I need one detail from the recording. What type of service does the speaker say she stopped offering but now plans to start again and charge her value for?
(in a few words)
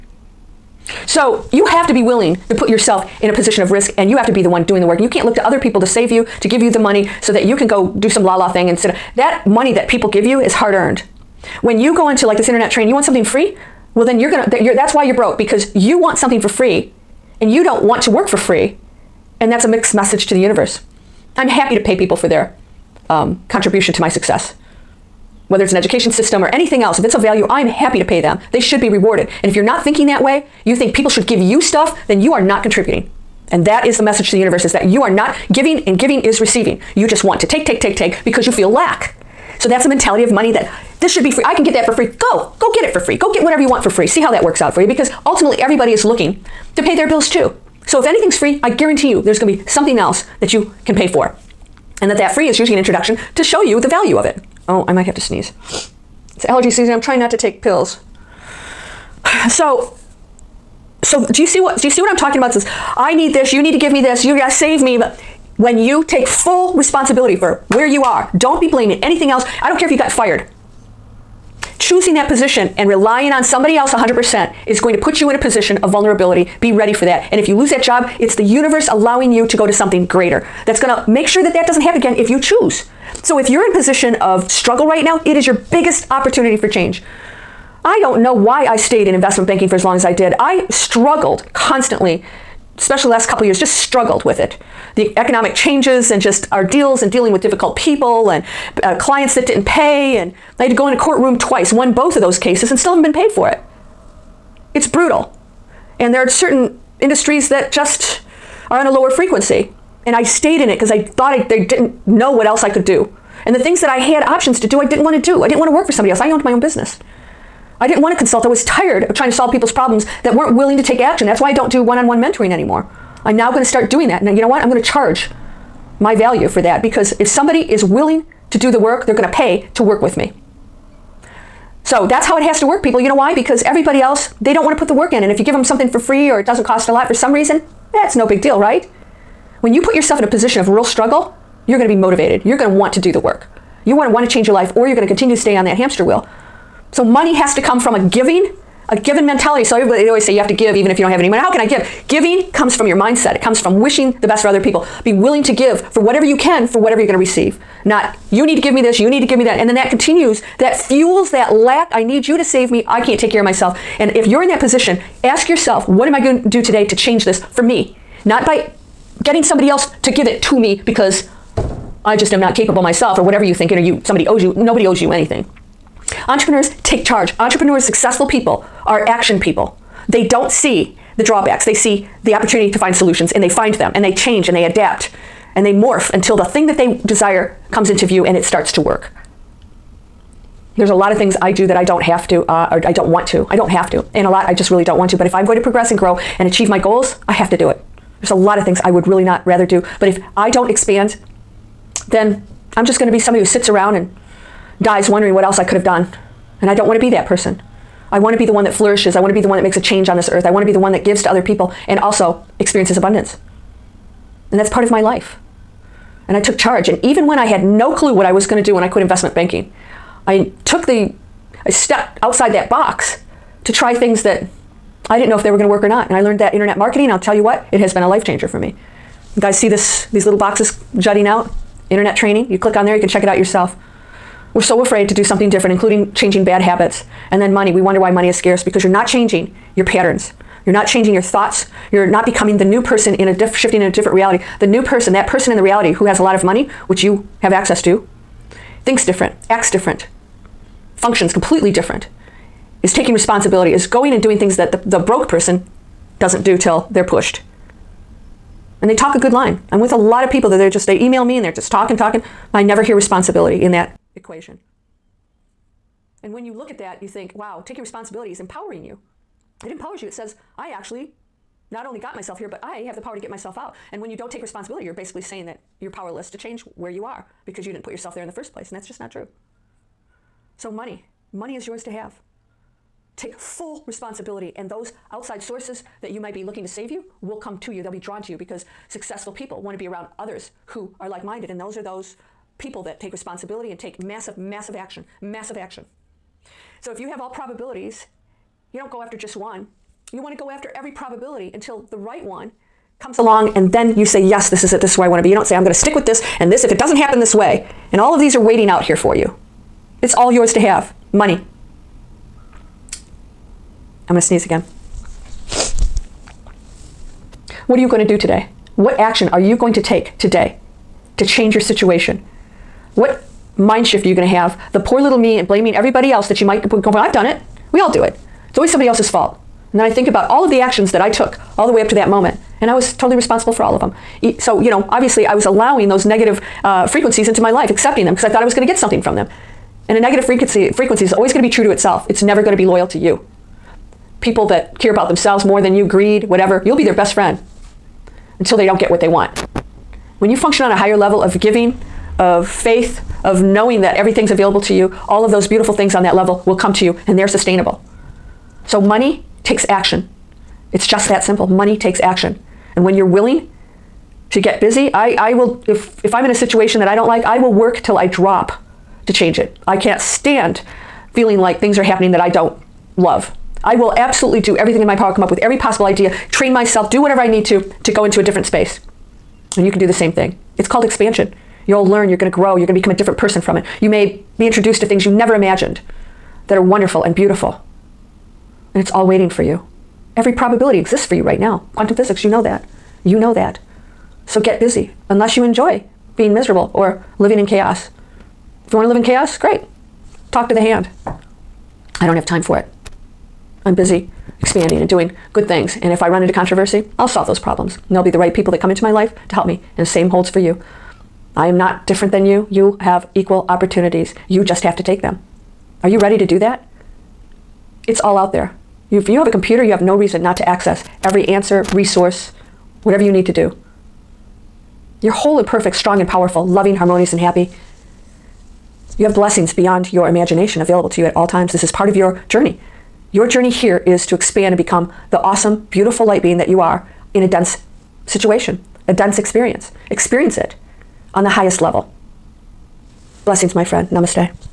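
one on one mentoring.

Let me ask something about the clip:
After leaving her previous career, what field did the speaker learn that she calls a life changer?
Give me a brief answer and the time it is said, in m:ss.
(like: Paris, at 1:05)
internet marketing, at 3:46.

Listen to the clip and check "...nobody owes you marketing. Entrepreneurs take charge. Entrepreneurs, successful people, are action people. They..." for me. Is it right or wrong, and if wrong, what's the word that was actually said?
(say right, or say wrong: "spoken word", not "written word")
wrong: "anything", not "marketing".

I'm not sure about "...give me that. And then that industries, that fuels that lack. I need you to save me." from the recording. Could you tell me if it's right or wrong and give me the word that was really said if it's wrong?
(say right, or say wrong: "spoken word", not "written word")
wrong: "continues", not "industries".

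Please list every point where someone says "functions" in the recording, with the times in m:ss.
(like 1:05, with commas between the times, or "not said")
4:10, 5:50.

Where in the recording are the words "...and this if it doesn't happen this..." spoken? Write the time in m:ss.
5:06.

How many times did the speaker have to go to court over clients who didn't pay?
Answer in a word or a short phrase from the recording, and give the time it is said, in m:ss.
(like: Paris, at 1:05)
2, at 1:41.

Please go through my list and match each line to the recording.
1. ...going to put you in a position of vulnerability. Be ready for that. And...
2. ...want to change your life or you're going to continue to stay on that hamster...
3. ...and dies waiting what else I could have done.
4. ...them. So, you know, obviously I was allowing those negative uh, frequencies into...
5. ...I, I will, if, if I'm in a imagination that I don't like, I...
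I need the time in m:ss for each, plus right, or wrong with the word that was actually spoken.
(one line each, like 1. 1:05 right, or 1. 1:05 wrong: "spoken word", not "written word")
1. 1:14 right
2. 2:24 right
3. 3:23 wrong: "wondering", not "waiting"
4. 5:33 right
5. 6:04 wrong: "situation", not "imagination".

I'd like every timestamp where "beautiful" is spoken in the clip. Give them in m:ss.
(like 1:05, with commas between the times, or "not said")
5:55, 6:27, 7:15.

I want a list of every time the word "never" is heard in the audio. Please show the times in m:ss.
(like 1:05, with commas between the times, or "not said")
4:22, 5:42, 6:25.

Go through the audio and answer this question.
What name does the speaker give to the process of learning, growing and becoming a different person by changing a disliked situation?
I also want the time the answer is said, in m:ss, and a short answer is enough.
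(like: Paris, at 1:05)
expansion, at 6:20.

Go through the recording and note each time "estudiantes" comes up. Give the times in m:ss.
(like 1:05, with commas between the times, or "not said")
not said.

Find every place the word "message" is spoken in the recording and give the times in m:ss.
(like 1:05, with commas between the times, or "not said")
0:19, 0:34.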